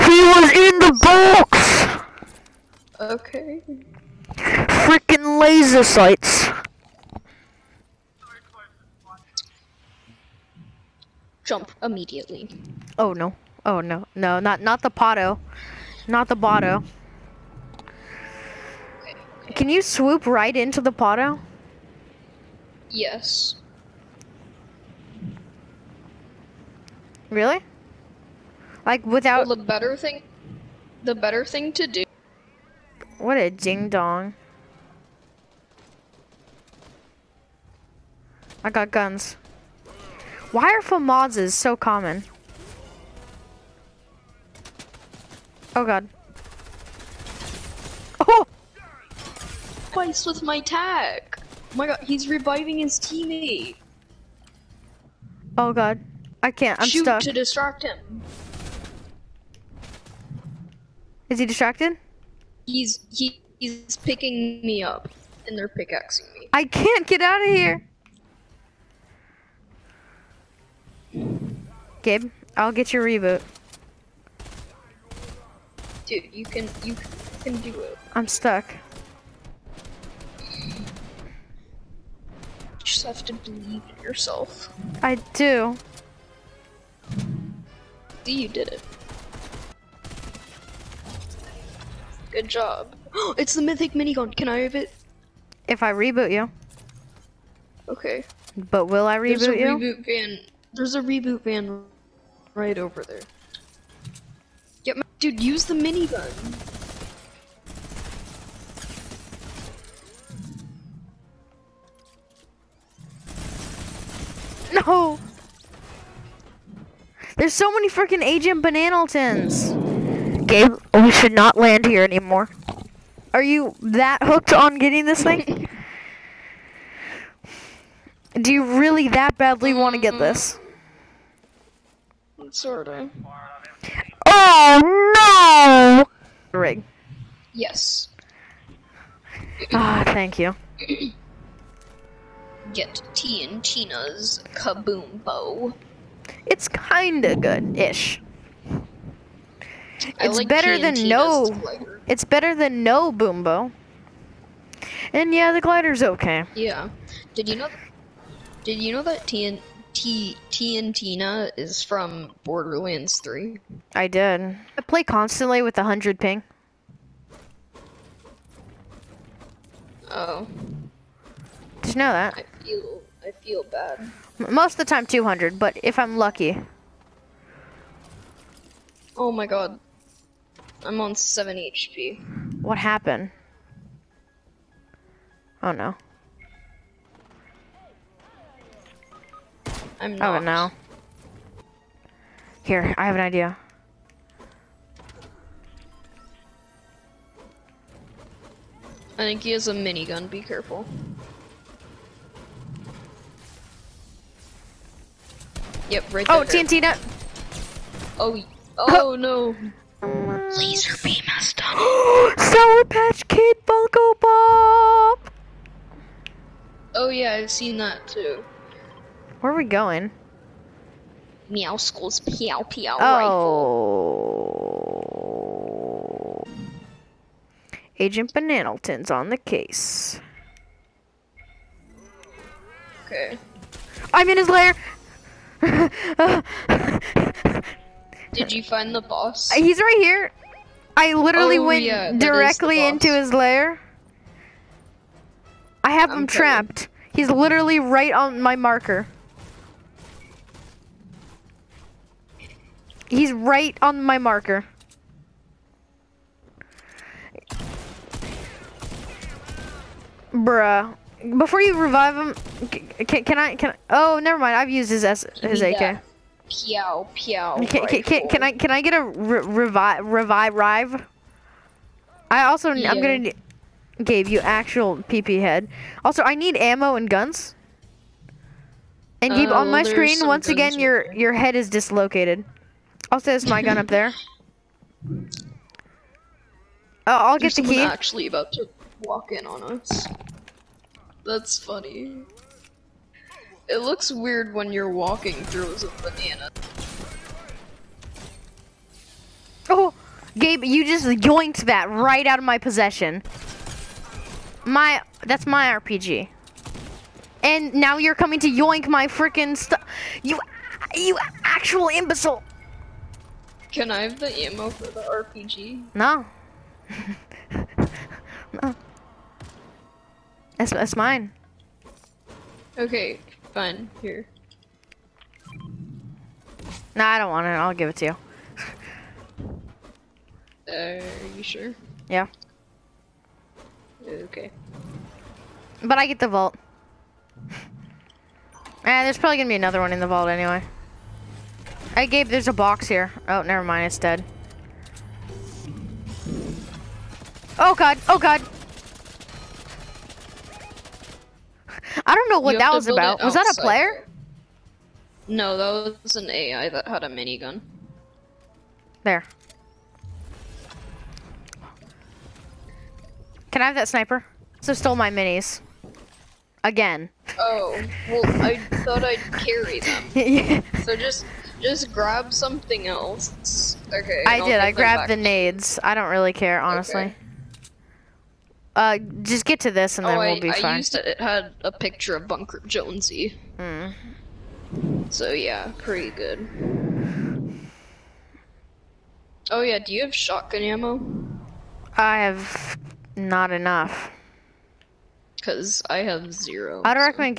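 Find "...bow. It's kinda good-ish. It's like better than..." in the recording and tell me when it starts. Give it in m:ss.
2:25.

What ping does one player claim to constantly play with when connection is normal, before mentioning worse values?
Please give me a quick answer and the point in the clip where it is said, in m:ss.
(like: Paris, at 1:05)
100, at 2:45.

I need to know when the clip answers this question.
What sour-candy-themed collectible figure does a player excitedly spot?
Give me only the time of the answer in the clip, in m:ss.
3:32.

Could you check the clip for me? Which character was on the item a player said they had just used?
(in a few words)
Bunker Jonesy.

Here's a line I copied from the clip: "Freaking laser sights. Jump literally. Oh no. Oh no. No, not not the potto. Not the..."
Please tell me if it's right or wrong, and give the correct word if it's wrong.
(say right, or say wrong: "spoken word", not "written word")
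wrong: "immediately", not "literally".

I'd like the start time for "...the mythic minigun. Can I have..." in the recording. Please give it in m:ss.
1:33.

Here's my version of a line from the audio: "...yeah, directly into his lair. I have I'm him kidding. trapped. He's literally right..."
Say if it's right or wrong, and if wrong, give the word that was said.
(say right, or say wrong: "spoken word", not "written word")
right.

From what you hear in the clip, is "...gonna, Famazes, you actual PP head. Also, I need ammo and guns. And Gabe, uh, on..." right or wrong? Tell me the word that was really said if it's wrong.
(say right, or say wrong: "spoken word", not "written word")
wrong: "Gabe", not "Famazes".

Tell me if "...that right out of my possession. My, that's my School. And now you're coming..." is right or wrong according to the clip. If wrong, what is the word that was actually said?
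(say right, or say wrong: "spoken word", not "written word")
wrong: "RPG", not "School".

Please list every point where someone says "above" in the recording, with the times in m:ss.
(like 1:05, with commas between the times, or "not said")
not said.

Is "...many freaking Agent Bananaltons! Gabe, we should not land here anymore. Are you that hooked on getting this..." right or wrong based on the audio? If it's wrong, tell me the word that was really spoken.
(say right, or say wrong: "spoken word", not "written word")
right.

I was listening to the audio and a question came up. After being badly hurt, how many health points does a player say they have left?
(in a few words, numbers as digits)
7.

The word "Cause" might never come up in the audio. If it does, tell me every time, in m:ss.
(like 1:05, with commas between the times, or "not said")
6:35.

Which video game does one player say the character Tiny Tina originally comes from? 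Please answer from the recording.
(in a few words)
Borderlands 3.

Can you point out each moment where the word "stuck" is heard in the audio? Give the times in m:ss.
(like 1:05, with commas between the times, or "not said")
0:57, 1:18.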